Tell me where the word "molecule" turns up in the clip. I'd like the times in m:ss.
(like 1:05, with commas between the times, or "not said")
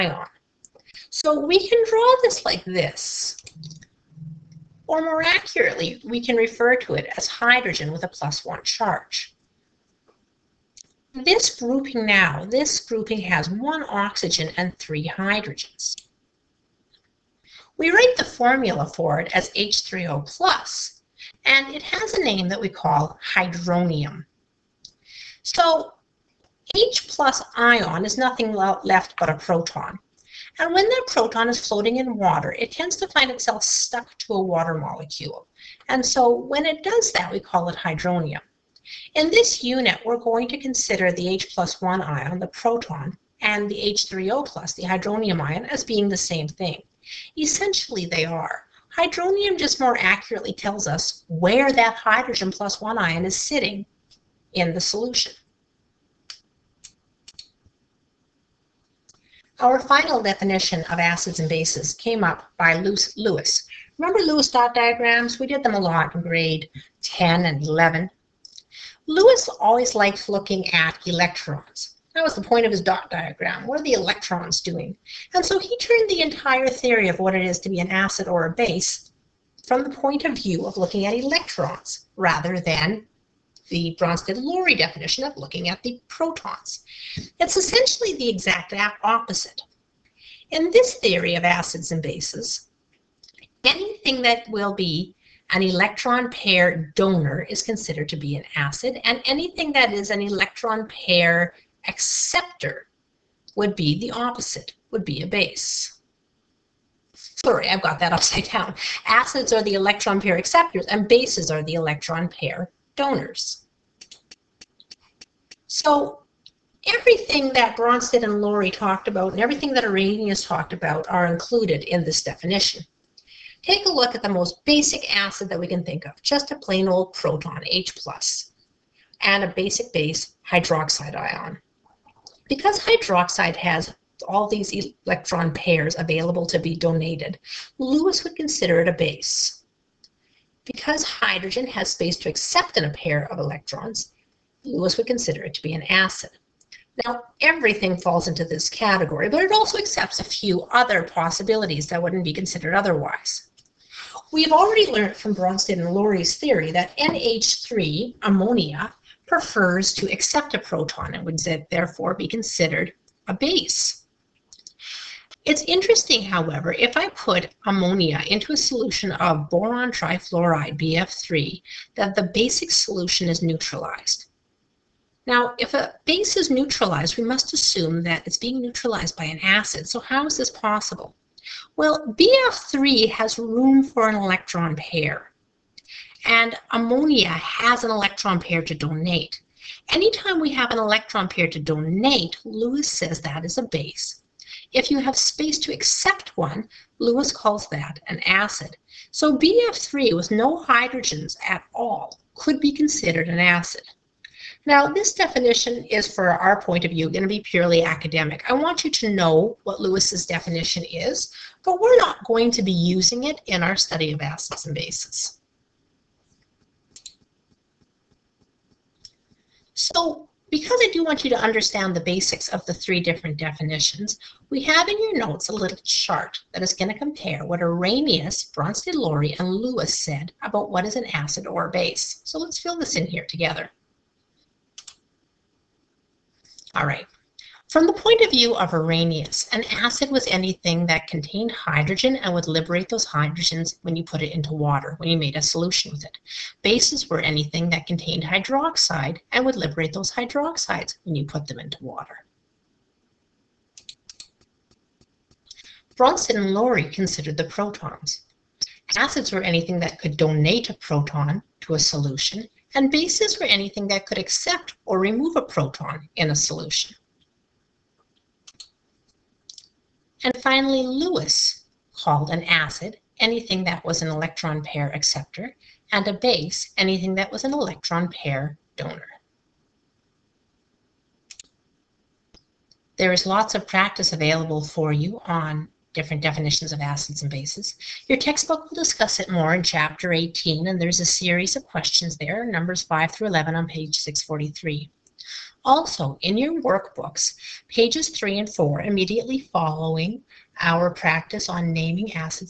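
0:34.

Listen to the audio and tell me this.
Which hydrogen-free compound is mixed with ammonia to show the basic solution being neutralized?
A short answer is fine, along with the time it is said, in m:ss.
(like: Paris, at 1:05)
boron trifluoride, at 2:49.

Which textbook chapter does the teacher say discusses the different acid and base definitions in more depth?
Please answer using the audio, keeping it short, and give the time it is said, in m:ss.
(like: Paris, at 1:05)
Chapter 18, at 4:49.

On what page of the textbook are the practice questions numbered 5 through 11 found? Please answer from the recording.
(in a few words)
643.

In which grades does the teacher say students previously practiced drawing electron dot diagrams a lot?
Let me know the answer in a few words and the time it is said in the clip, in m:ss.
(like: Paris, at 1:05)
grade 10 and 11, at 1:06.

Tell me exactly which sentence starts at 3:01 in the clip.
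Well, BF3 has room for an electron pair, and ammonia has an electron pair to donate.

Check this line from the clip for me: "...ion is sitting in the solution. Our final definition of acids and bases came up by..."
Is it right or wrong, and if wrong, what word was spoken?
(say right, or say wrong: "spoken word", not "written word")
right.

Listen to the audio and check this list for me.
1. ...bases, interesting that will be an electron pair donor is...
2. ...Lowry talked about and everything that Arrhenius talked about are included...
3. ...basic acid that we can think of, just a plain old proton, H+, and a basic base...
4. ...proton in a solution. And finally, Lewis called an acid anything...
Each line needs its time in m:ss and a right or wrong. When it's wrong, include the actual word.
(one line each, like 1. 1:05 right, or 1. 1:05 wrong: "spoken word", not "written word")
1. 1:32 wrong: "anything", not "interesting"
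2. 1:58 right
3. 2:04 right
4. 4:25 right.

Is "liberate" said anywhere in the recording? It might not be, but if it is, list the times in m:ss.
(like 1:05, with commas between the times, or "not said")
4:02, 4:09.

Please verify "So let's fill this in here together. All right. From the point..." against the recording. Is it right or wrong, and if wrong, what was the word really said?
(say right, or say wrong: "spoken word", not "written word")
right.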